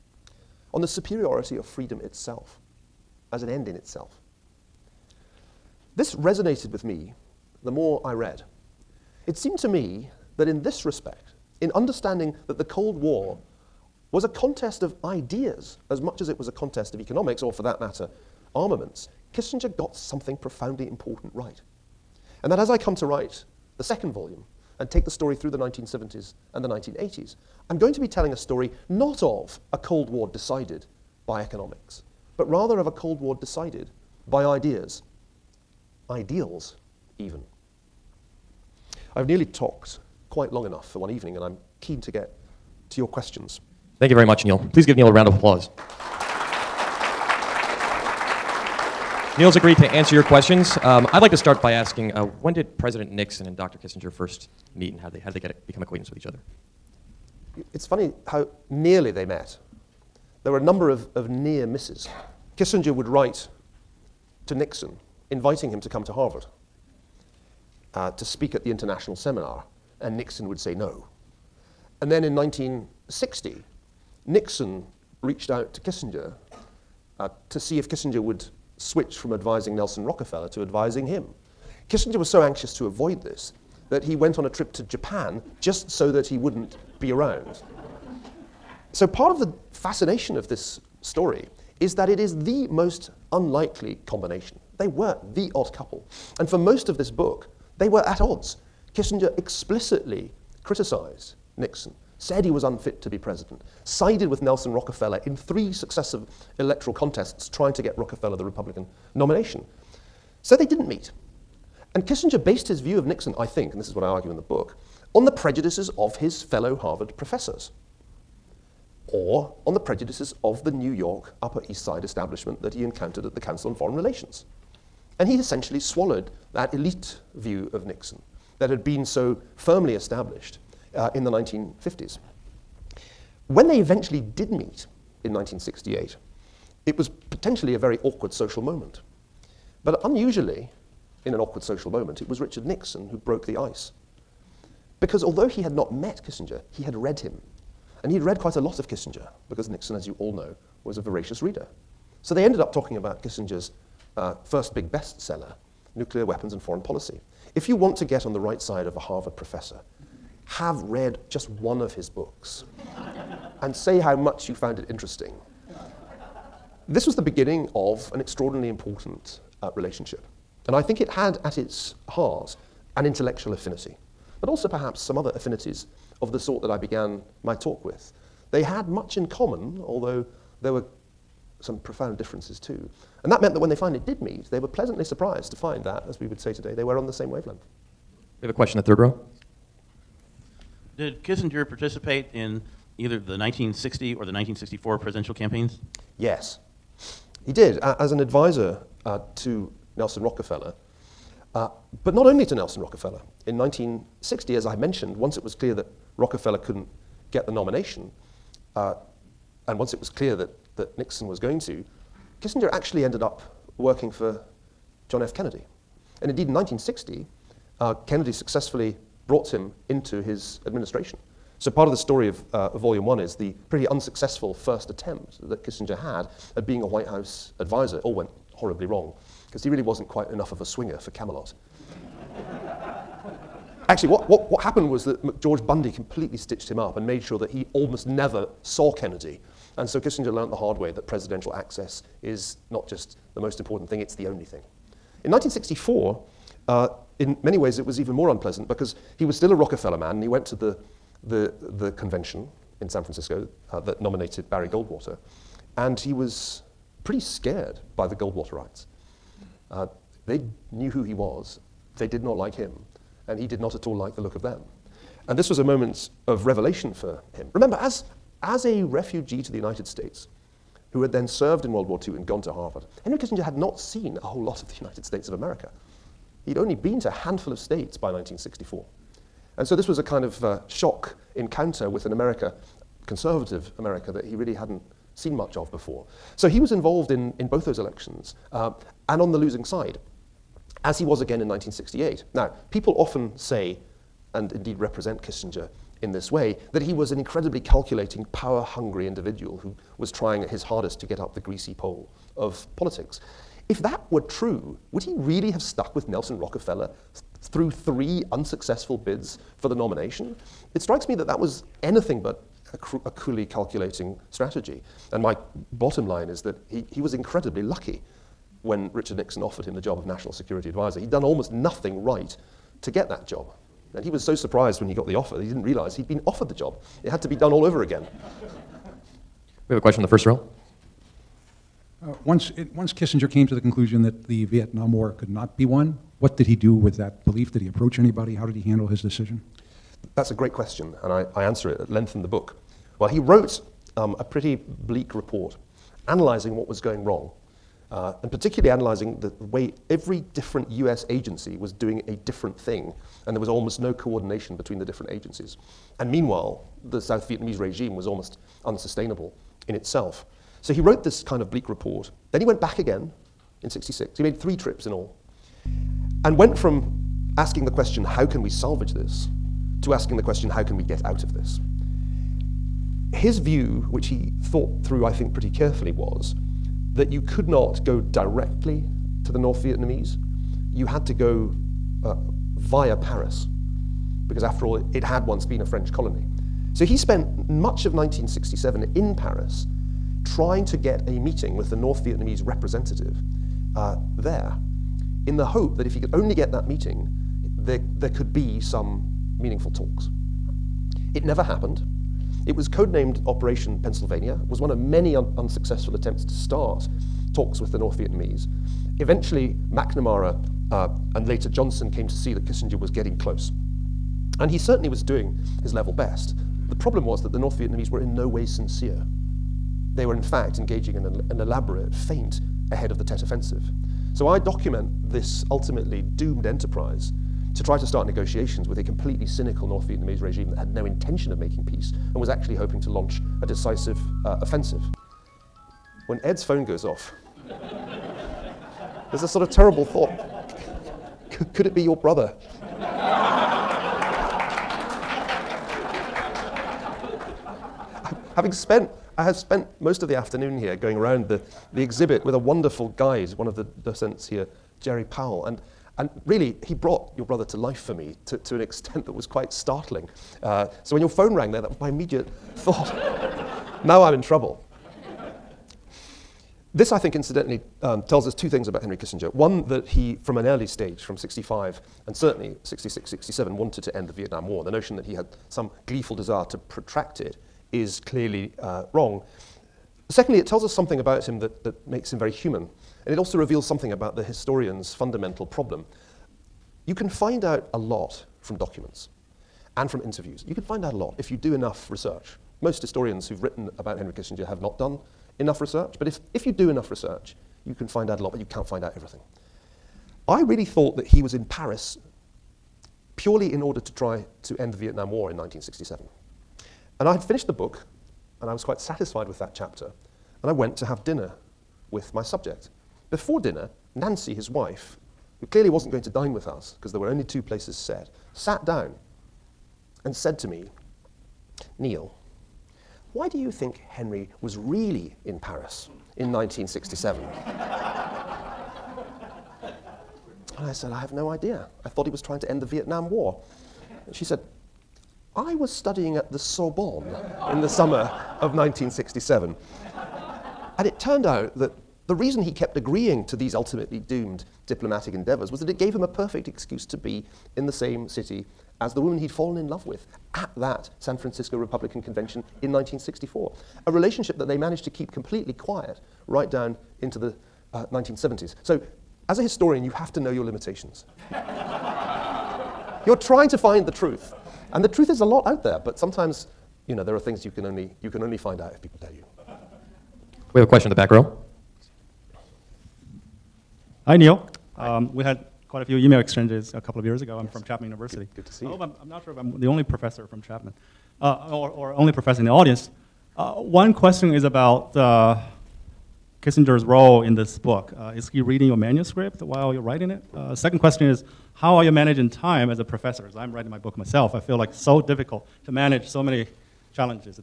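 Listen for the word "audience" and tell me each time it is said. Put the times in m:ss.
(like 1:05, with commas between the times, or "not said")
9:42.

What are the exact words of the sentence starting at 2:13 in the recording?
When they eventually did meet in 1968, it was potentially a very awkward social moment.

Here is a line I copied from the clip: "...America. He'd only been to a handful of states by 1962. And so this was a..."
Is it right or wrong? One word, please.
wrong.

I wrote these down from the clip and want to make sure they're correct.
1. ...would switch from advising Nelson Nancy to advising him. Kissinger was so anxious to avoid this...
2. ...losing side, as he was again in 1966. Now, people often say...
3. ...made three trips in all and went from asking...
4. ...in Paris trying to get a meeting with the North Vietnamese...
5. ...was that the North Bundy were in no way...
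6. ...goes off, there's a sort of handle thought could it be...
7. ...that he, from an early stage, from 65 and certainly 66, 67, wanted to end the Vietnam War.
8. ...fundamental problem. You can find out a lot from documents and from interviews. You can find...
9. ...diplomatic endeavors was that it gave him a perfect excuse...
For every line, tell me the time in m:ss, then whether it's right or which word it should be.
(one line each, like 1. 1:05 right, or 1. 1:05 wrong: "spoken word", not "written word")
1. 1:18 wrong: "Rockefeller", not "Nancy"
2. 4:49 wrong: "1968", not "1966"
3. 6:04 right
4. 6:28 right
5. 6:57 wrong: "Vietnamese", not "Bundy"
6. 7:16 wrong: "terrible", not "handle"
7. 7:49 right
8. 8:04 right
9. 9:04 right.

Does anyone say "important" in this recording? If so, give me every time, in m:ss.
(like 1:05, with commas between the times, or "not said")
0:20, 2:48, 4:03.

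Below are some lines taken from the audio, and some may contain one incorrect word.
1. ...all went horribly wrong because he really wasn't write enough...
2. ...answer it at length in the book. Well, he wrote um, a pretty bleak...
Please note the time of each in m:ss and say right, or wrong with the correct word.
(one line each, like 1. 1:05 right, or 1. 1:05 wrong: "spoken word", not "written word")
1. 3:48 wrong: "quite", not "write"
2. 5:41 right.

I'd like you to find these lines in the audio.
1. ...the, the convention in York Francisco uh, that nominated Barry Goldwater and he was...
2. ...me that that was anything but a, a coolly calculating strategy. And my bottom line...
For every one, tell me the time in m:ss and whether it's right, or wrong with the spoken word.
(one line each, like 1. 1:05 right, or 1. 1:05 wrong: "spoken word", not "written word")
1. 4:11 wrong: "San", not "York"
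2. 5:11 right.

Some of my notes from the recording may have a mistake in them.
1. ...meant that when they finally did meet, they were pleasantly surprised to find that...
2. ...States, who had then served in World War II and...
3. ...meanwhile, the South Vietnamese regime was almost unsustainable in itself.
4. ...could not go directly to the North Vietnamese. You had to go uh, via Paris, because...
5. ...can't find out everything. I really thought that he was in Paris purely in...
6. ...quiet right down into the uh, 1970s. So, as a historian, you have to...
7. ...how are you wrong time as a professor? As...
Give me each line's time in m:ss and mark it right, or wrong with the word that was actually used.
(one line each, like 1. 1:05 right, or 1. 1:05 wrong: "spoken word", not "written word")
1. 3:03 right
2. 4:29 right
3. 5:56 right
4. 6:17 right
5. 8:18 right
6. 9:15 right
7. 9:51 wrong: "managing", not "wrong".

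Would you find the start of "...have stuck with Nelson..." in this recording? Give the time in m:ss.
5:05.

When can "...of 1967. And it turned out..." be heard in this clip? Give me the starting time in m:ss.
8:58.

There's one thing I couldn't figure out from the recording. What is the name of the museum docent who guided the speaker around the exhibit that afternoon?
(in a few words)
Jerry Powell.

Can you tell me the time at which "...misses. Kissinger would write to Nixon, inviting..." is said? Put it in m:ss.
1:01.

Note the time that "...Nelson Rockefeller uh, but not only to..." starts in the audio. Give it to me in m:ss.
3:19.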